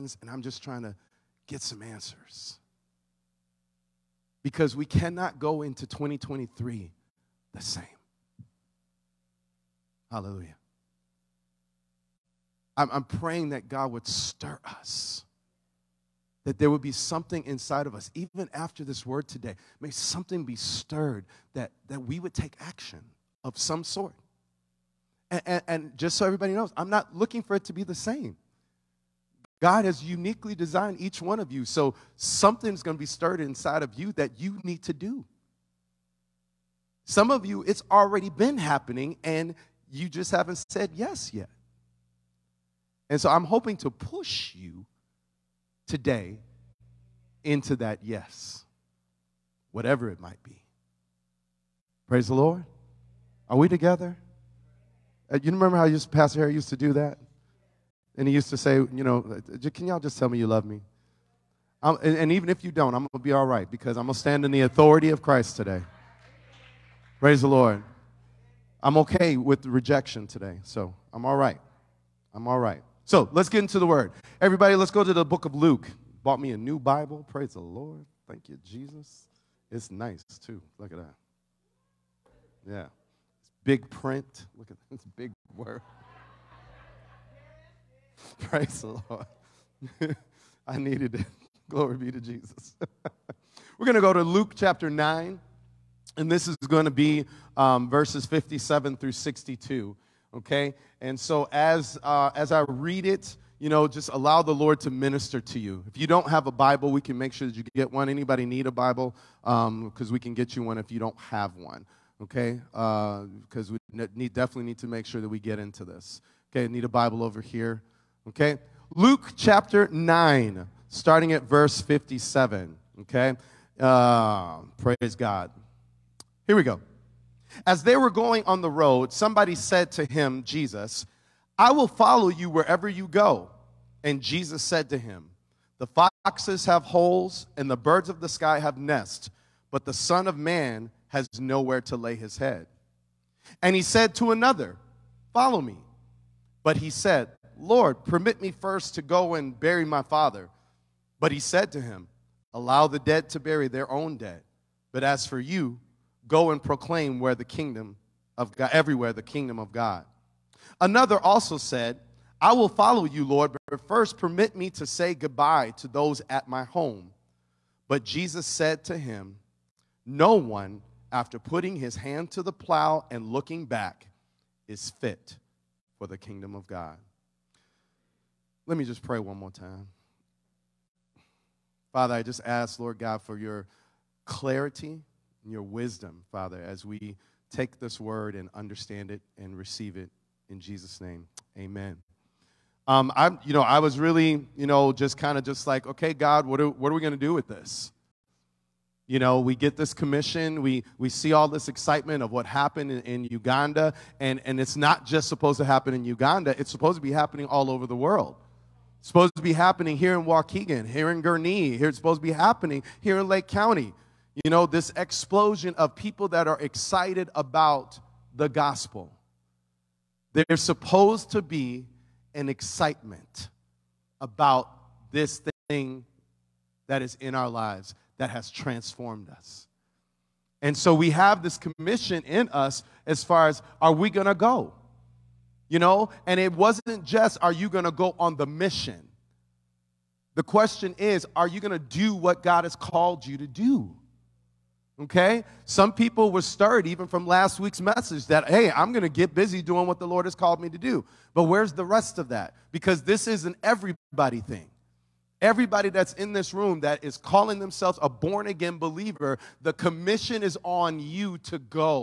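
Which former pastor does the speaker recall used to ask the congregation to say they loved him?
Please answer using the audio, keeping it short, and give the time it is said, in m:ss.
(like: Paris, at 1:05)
Pastor Harry, at 0:56.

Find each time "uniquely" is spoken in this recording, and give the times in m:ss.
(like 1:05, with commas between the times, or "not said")
0:30.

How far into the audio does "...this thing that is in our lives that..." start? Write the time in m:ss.
3:45.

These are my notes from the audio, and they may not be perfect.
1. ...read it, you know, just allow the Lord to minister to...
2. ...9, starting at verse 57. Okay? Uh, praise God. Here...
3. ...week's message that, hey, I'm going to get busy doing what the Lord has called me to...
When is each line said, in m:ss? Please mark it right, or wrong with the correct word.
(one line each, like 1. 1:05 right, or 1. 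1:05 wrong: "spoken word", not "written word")
1. 1:42 right
2. 1:59 right
3. 4:07 right.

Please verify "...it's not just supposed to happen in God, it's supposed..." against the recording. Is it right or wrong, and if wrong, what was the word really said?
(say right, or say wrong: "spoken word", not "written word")
wrong: "Uganda", not "God".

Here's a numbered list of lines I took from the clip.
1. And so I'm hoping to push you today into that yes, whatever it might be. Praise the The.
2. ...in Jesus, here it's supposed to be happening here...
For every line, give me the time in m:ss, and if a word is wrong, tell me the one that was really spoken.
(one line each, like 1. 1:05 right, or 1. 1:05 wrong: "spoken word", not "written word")
1. 0:43 wrong: "Lord", not "The"
2. 3:31 wrong: "Gurnee", not "Jesus".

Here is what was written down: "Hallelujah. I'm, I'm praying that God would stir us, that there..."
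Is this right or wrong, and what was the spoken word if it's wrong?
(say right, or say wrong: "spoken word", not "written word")
right.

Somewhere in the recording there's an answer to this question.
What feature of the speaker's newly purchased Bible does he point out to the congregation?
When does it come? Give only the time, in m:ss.
1:23.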